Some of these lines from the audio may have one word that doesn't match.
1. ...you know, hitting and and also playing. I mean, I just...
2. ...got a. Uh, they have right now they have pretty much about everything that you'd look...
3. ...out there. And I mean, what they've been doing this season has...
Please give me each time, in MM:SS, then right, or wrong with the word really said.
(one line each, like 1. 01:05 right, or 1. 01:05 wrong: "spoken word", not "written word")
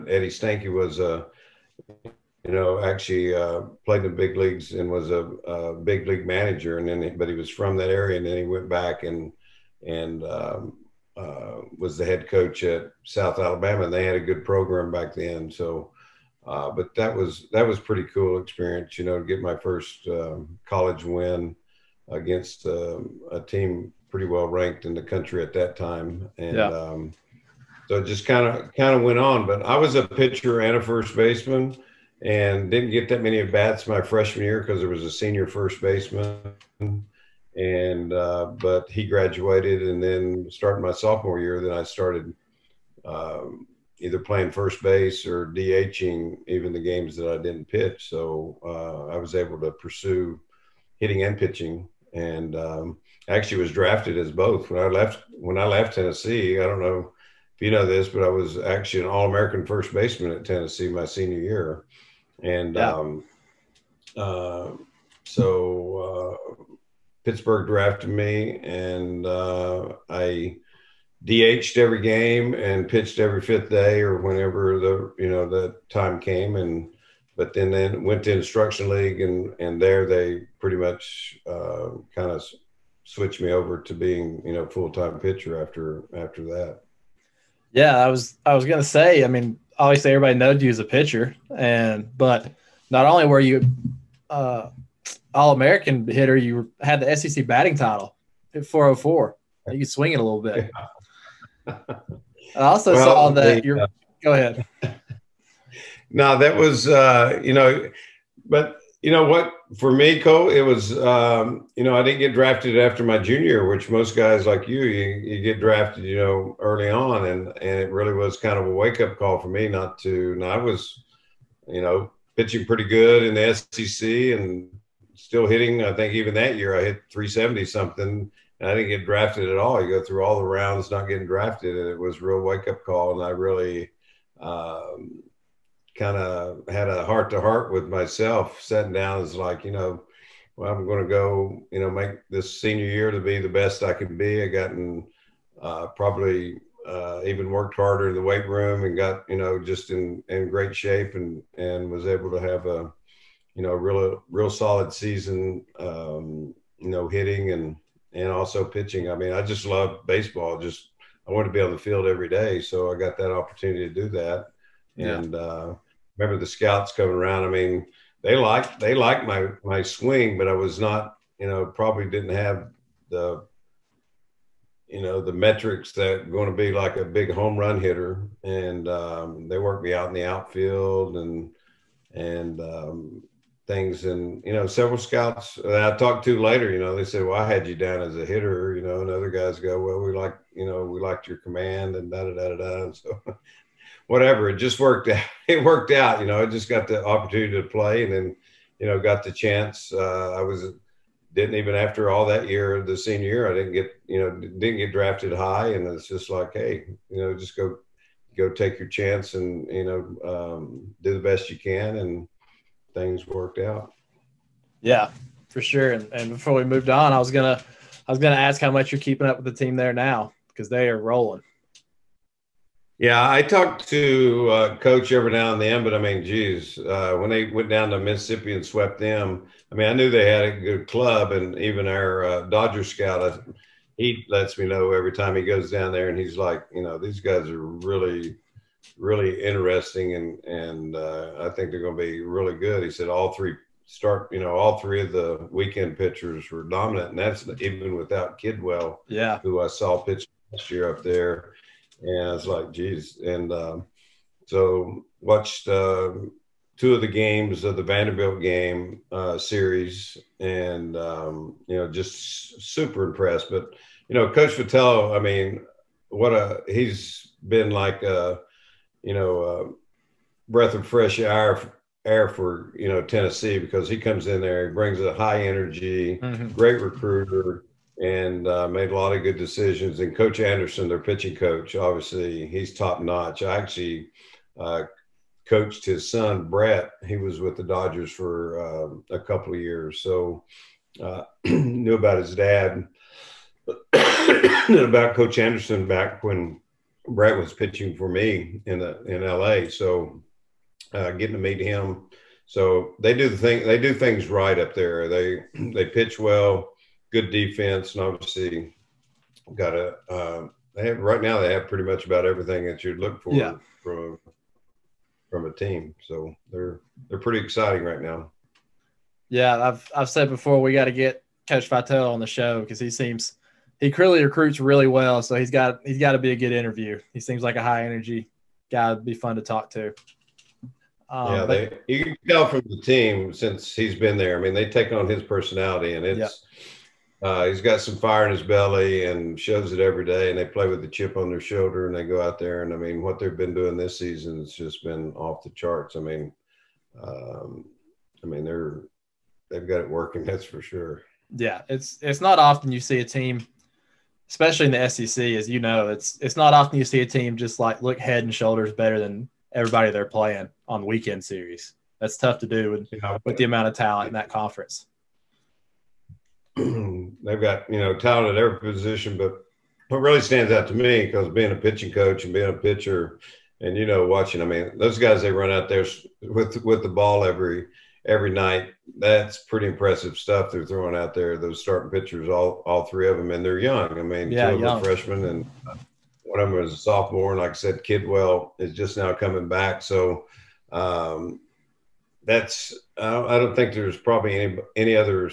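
1. 02:36 wrong: "pitching", not "playing"
2. 05:09 right
3. 05:42 right.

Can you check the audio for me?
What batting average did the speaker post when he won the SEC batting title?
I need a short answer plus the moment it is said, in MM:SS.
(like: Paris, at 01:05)
404, at 01:38.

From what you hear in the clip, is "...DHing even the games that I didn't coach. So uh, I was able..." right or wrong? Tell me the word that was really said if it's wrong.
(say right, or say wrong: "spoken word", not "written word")
wrong: "pitch", not "coach".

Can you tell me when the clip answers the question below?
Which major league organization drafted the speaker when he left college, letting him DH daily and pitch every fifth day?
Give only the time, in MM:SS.
01:07.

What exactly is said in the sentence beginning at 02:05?
I think even that year I hit 370 something, and I didn't get drafted at all.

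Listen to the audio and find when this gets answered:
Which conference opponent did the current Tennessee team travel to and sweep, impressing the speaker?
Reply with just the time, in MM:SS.
03:47.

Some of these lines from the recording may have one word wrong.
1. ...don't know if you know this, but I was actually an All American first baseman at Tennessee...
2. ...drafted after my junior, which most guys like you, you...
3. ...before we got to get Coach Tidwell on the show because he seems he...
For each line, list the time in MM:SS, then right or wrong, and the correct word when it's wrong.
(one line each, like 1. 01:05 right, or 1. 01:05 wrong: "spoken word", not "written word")
1. 00:56 right
2. 01:52 right
3. 05:20 wrong: "Vitale", not "Tidwell".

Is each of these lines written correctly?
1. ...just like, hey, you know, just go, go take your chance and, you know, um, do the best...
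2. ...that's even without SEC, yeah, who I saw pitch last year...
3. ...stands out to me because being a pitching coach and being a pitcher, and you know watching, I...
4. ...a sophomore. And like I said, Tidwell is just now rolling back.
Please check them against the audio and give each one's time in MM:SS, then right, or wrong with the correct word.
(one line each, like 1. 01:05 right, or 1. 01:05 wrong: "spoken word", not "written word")
1. 03:26 right
2. 04:07 wrong: "Tidwell", not "SEC"
3. 06:10 right
4. 06:26 wrong: "coming", not "rolling".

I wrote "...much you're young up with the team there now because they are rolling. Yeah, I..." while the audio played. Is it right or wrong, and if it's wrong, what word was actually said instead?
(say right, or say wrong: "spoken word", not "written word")
wrong: "keeping", not "young".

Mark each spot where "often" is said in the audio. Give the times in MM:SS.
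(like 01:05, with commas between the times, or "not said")
05:52, 05:56.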